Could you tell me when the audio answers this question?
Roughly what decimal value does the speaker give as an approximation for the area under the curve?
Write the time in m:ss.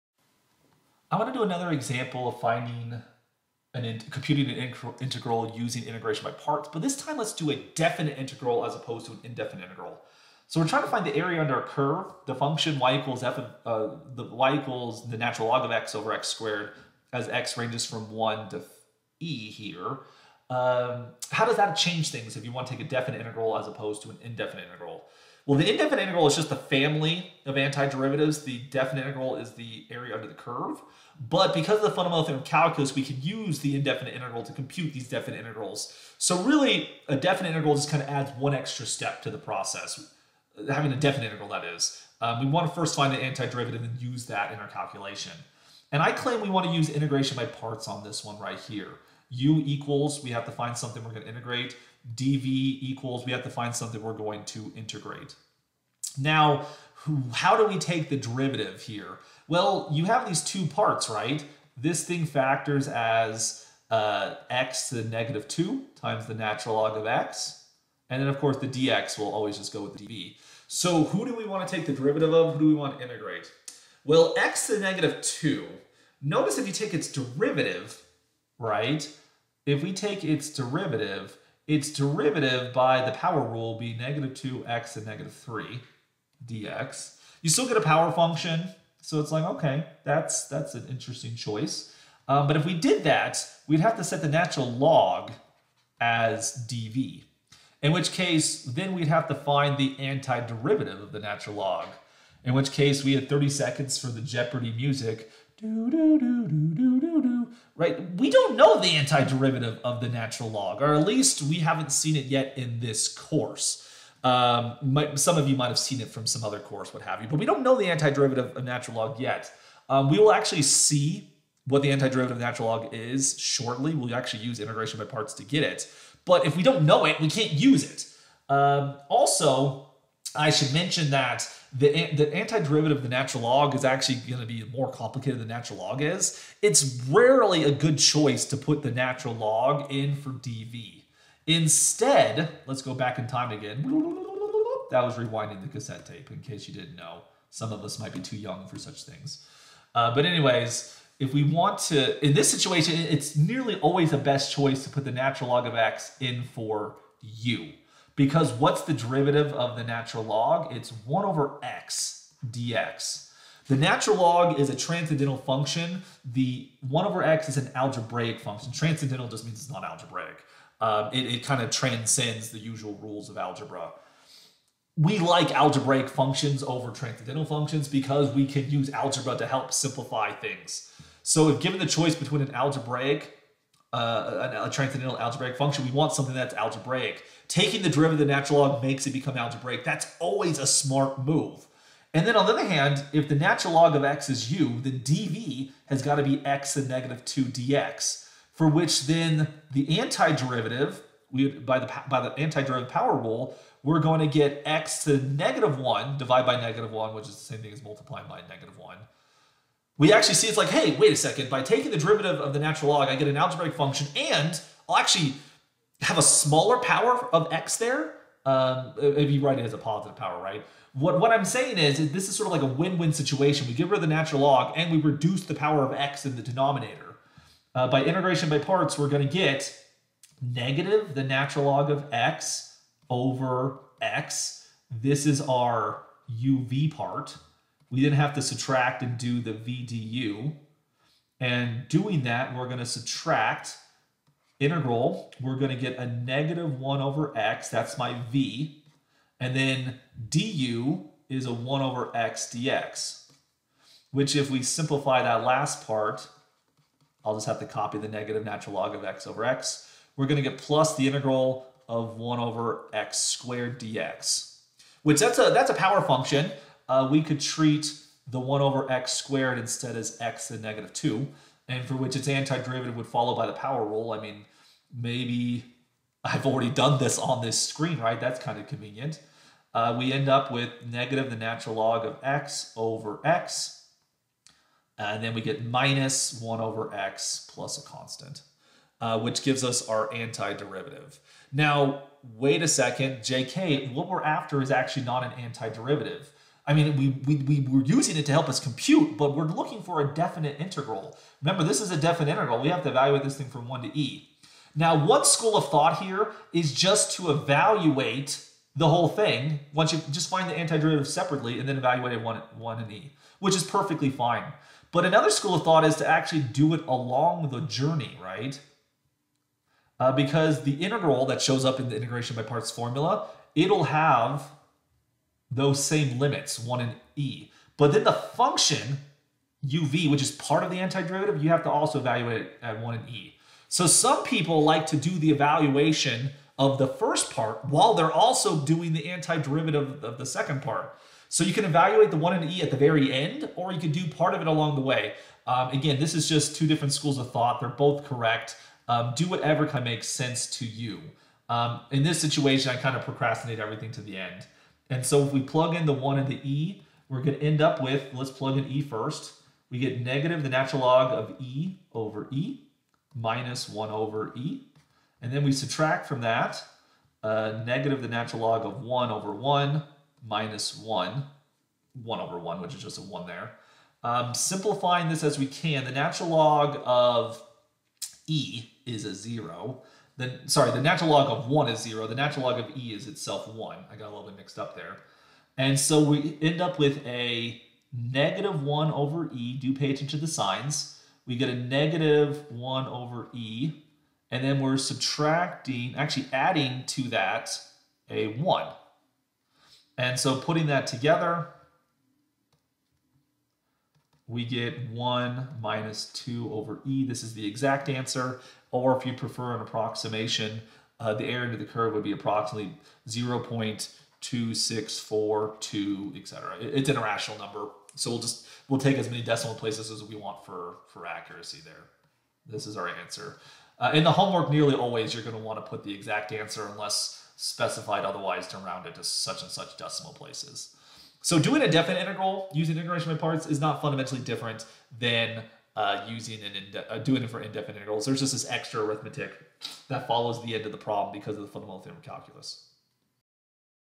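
6:53.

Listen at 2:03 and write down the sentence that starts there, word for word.
We'll actually use integration by parts to get it.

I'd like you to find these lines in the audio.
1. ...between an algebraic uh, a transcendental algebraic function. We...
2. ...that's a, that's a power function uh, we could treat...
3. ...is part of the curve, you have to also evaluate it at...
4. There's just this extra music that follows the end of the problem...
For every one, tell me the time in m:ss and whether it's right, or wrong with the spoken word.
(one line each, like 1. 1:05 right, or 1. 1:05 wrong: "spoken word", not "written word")
1. 3:02 right
2. 4:25 right
3. 5:30 wrong: "antiderivative", not "curve"
4. 7:18 wrong: "arithmetic", not "music".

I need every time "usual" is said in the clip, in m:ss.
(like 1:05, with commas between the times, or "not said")
2:52.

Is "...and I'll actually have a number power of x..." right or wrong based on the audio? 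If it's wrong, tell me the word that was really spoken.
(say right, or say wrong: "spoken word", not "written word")
wrong: "smaller", not "number".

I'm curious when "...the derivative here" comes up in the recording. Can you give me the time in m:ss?
0:58.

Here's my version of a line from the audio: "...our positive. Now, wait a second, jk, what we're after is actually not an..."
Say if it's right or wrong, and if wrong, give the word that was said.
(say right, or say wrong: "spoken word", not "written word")
wrong: "antiderivative", not "positive".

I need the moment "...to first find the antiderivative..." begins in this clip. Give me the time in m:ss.
0:42.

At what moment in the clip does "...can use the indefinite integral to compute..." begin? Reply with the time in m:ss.
0:33.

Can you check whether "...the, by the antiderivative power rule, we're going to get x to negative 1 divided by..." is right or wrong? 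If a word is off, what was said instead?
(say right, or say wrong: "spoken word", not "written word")
right.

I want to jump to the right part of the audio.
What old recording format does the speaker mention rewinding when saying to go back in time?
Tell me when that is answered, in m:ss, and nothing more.
2:25.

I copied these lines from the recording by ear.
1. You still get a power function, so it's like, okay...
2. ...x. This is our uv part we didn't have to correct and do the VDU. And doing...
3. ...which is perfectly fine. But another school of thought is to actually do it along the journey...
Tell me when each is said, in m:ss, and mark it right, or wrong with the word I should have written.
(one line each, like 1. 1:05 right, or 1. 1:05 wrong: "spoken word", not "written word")
1. 1:27 right
2. 3:54 wrong: "subtract", not "correct"
3. 5:13 right.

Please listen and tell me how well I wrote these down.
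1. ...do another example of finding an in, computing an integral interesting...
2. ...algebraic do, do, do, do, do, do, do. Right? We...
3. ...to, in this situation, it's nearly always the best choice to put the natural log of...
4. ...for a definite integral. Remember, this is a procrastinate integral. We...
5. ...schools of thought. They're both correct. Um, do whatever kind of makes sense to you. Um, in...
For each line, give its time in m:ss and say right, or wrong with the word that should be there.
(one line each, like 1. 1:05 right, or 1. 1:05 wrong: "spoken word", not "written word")
1. 0:01 wrong: "using", not "interesting"
2. 1:44 wrong: "music", not "algebraic"
3. 2:31 right
4. 4:59 wrong: "definite", not "procrastinate"
5. 5:46 right.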